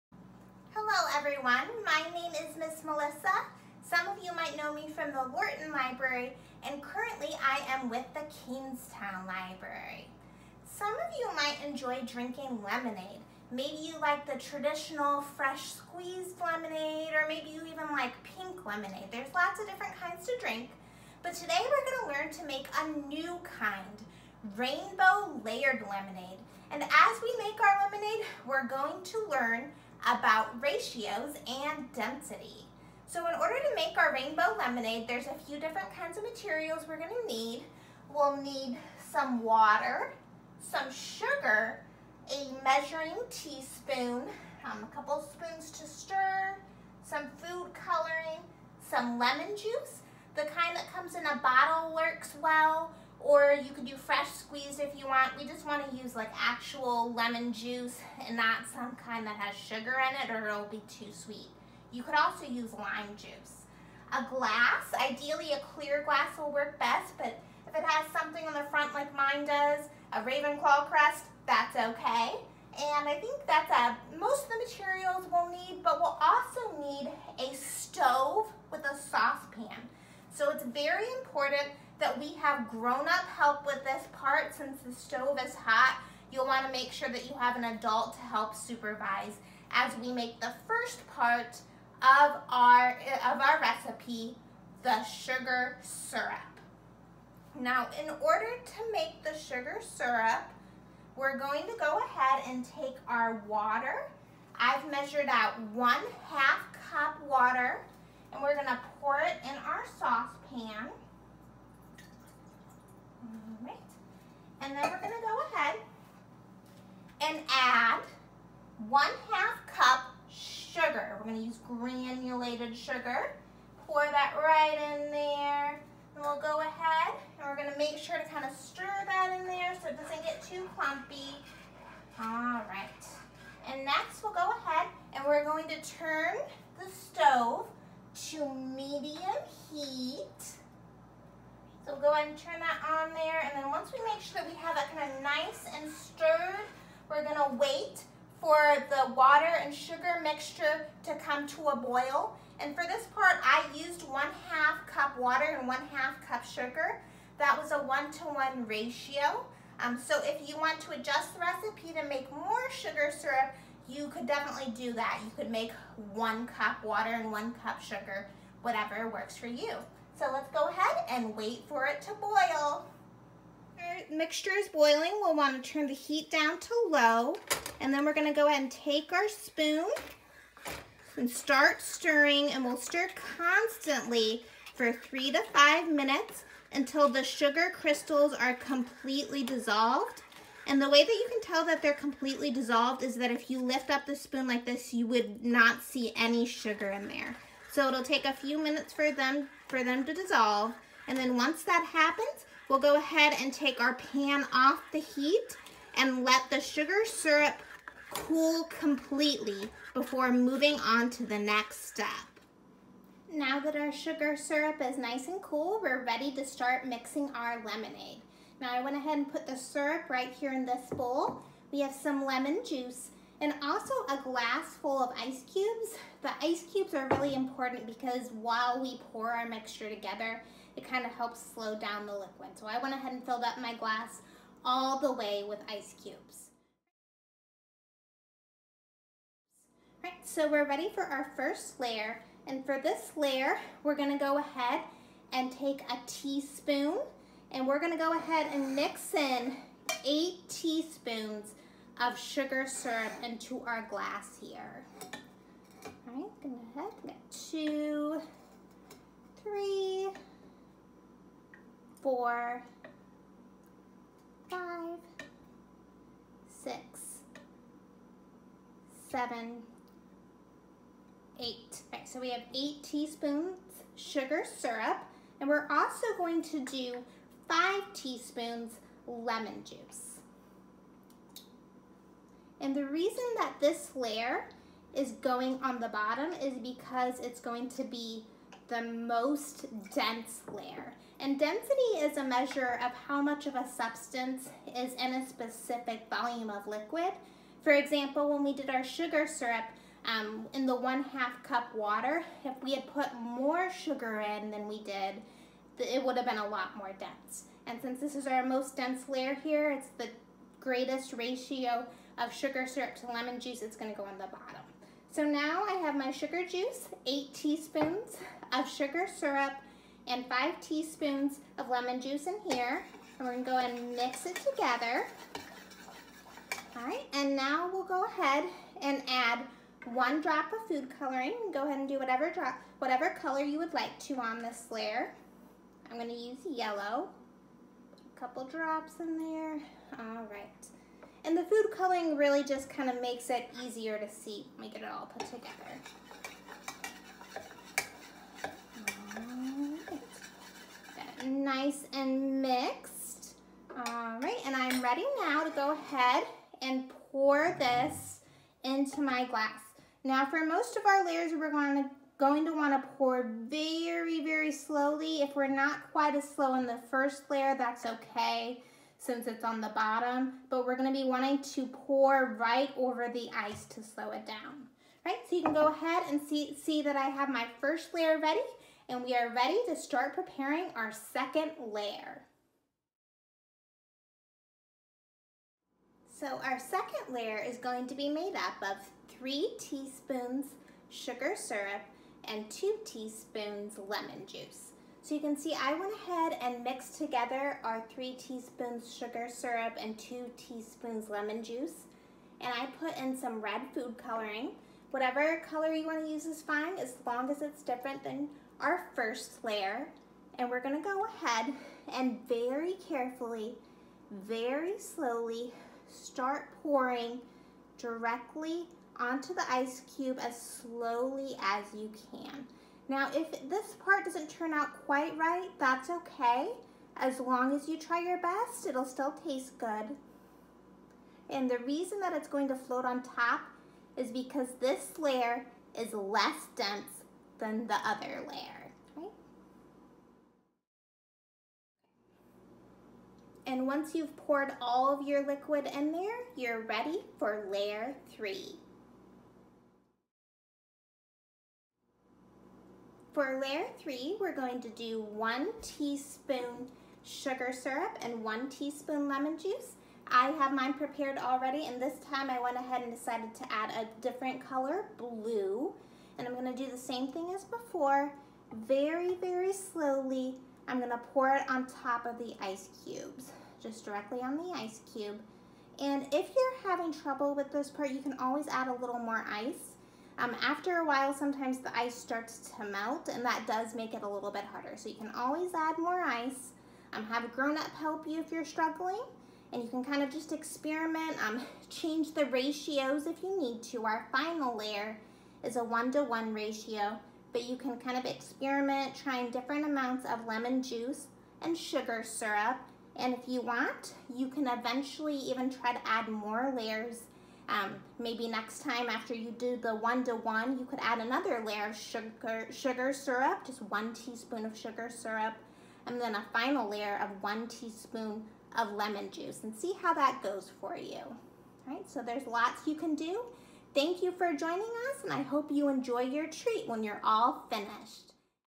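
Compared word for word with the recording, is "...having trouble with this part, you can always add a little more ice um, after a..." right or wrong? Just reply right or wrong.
right.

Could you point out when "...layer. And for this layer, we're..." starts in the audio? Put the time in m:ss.
4:01.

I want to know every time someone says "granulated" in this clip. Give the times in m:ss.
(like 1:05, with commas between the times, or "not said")
2:01.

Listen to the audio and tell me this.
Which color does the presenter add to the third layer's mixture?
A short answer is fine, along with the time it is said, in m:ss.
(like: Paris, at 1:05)
blue, at 7:44.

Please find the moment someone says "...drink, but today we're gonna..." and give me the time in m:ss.
0:20.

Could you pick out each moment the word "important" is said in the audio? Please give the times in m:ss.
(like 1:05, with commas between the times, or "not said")
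1:21, 3:47.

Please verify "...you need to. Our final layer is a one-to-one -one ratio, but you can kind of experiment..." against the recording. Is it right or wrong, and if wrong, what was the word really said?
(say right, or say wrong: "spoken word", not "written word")
right.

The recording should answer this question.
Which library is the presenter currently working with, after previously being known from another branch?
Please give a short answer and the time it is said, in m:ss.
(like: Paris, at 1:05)
Kingstowne Library, at 0:08.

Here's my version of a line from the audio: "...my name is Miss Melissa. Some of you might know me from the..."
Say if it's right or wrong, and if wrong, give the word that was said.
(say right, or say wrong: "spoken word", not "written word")
right.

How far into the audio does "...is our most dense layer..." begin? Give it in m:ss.
5:08.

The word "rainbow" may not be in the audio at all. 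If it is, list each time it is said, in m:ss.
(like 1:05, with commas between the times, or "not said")
0:24, 0:34.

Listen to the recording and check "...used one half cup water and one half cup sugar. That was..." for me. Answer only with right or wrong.
right.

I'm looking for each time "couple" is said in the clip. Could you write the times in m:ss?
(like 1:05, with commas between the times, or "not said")
0:44, 5:38.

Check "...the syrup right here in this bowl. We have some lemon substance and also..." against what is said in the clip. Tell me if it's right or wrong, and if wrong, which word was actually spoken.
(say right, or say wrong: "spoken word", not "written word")
wrong: "juice", not "substance".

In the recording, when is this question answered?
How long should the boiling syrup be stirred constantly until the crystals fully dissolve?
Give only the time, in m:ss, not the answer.
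3:04.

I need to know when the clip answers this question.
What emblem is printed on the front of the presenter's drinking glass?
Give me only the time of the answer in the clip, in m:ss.
1:10.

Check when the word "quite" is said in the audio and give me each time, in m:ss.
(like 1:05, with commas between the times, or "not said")
6:05, 7:04.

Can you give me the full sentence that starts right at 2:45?
You could make one cup water and one cup sugar, whatever works for you.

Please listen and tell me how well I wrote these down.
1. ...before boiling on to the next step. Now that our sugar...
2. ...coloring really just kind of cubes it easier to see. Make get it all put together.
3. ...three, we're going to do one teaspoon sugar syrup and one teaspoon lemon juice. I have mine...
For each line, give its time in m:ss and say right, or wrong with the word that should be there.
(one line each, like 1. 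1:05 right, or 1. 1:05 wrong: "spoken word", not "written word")
1. 3:29 wrong: "moving", not "boiling"
2. 5:41 wrong: "makes", not "cubes"
3. 7:33 right.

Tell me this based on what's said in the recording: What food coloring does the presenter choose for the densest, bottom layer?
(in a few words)
yellow.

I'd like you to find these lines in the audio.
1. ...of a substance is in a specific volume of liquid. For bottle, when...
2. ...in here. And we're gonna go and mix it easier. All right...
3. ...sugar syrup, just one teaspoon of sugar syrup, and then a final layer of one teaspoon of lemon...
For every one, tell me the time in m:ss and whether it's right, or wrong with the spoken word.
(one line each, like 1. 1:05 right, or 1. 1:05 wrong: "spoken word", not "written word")
1. 4:53 wrong: "example", not "bottle"
2. 5:22 wrong: "together", not "easier"
3. 8:32 right.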